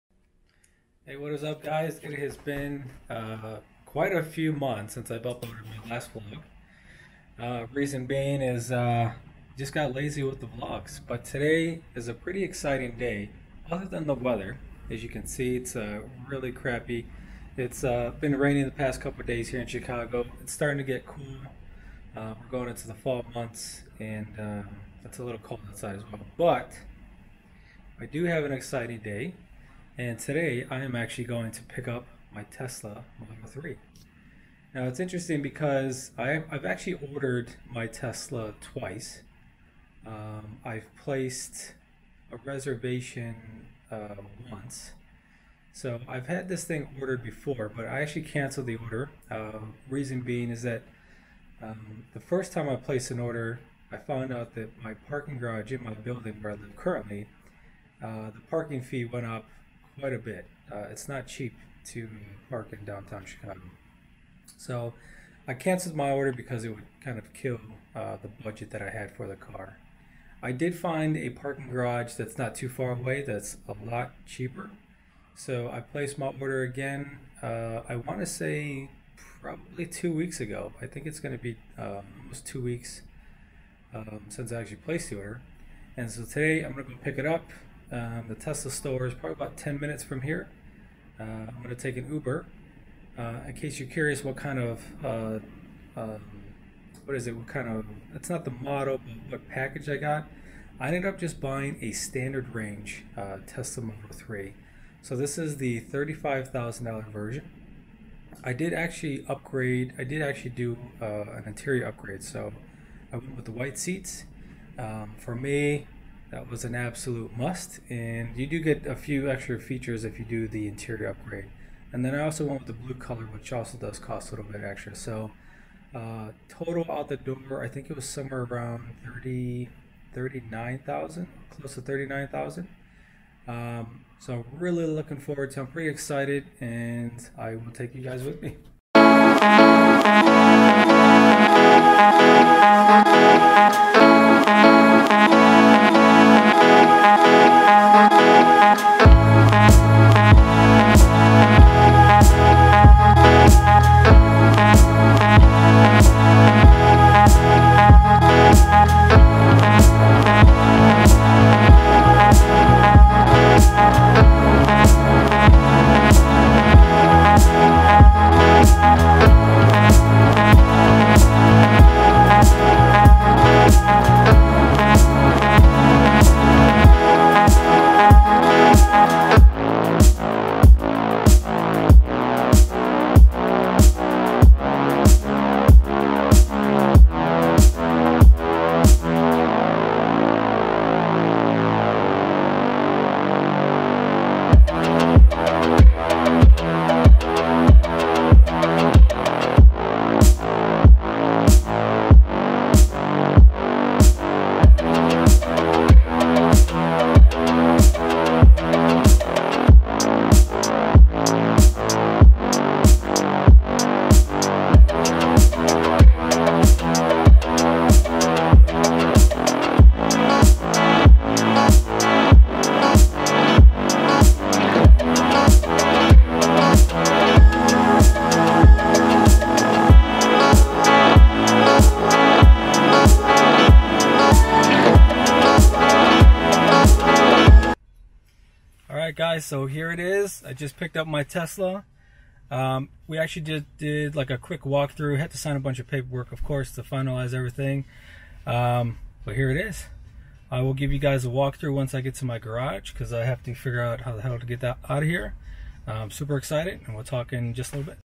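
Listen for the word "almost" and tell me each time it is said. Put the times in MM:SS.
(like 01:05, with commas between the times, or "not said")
01:22.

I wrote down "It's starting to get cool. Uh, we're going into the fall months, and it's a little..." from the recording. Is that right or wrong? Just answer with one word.
right.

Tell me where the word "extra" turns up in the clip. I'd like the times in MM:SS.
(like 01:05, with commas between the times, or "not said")
01:59, 02:04.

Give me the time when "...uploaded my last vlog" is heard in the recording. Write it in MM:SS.
00:05.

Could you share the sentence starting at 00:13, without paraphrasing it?
Other than the weather, as you can see, it's uh, really crappy.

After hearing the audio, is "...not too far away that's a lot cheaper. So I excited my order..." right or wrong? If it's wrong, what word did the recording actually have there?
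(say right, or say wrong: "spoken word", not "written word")
wrong: "placed", not "excited".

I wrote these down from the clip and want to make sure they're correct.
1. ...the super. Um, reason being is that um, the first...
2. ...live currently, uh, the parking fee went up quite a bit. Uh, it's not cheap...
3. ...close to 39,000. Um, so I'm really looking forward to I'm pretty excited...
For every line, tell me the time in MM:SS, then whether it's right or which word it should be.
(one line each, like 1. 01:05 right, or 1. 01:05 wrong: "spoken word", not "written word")
1. 00:48 wrong: "order", not "super"
2. 00:56 right
3. 02:11 right.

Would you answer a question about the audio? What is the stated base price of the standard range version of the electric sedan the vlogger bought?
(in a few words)
$35,000.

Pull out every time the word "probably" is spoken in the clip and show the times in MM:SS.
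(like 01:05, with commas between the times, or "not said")
01:19, 01:29.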